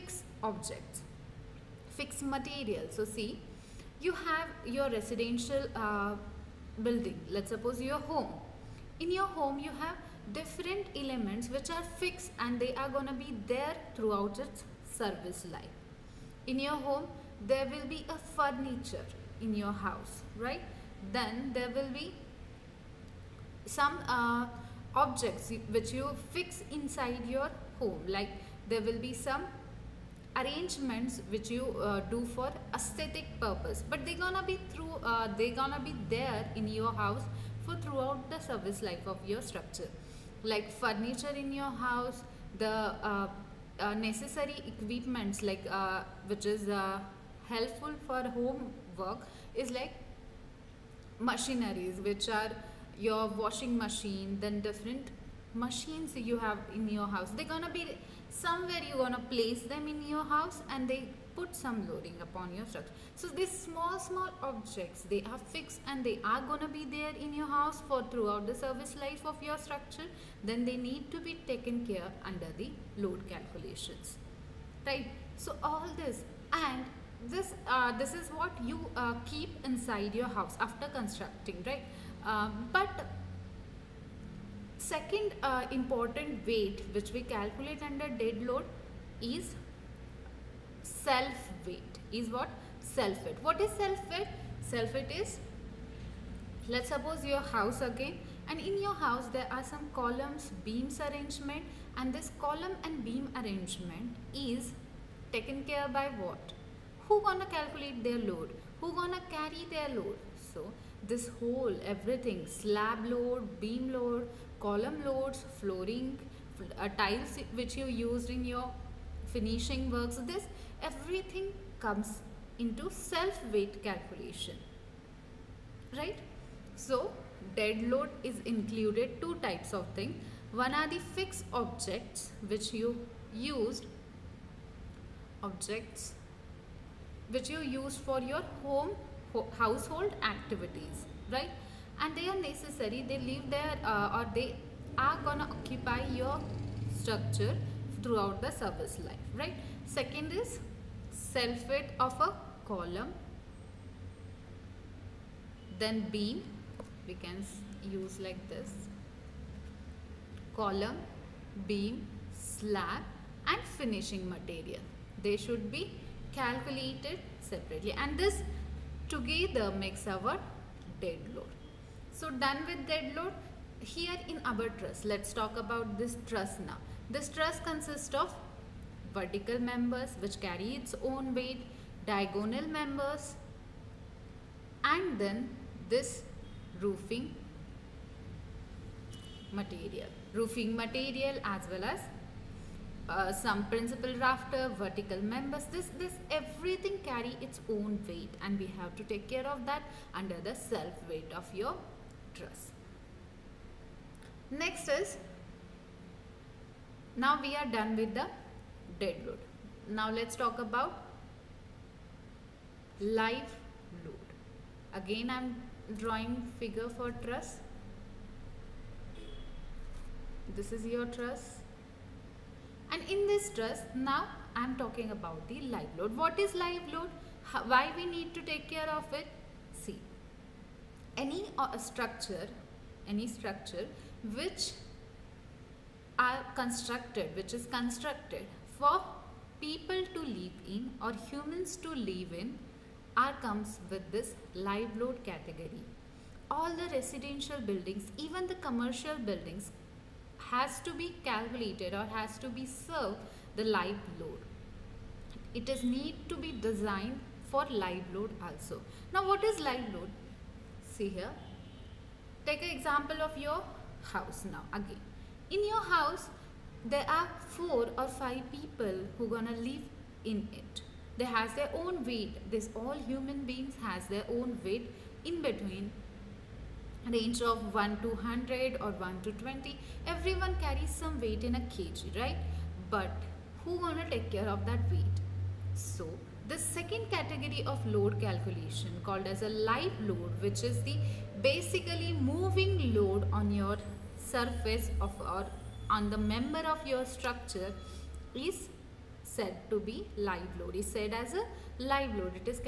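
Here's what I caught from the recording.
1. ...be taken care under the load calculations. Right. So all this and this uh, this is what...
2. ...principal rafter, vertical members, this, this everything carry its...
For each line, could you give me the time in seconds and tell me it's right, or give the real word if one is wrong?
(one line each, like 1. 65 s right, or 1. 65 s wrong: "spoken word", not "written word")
1. 71 s right
2. 193 s right.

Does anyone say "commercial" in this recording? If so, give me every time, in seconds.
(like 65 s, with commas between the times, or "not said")
248 s.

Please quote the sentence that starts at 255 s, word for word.
It is need to be designed for live load also.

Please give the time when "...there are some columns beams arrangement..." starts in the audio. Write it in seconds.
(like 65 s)
99 s.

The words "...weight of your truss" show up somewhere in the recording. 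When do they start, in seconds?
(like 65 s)
201 s.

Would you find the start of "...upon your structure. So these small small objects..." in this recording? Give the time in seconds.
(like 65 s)
62 s.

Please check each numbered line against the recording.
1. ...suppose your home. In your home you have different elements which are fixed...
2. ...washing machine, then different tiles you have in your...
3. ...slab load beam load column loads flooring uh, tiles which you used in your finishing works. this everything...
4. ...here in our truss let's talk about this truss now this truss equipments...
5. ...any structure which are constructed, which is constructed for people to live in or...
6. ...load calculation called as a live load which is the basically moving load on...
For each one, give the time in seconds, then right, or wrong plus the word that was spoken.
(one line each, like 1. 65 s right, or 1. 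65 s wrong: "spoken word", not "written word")
1. 7 s right
2. 53 s wrong: "machines", not "tiles"
3. 112 s right
4. 173 s wrong: "consists", not "equipments"
5. 233 s right
6. 287 s right.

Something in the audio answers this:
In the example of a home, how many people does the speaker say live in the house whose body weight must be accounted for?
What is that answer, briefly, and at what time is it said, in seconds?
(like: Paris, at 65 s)
4 or 5, at 267 s.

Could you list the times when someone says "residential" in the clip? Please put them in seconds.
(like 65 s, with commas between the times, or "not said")
4 s, 246 s.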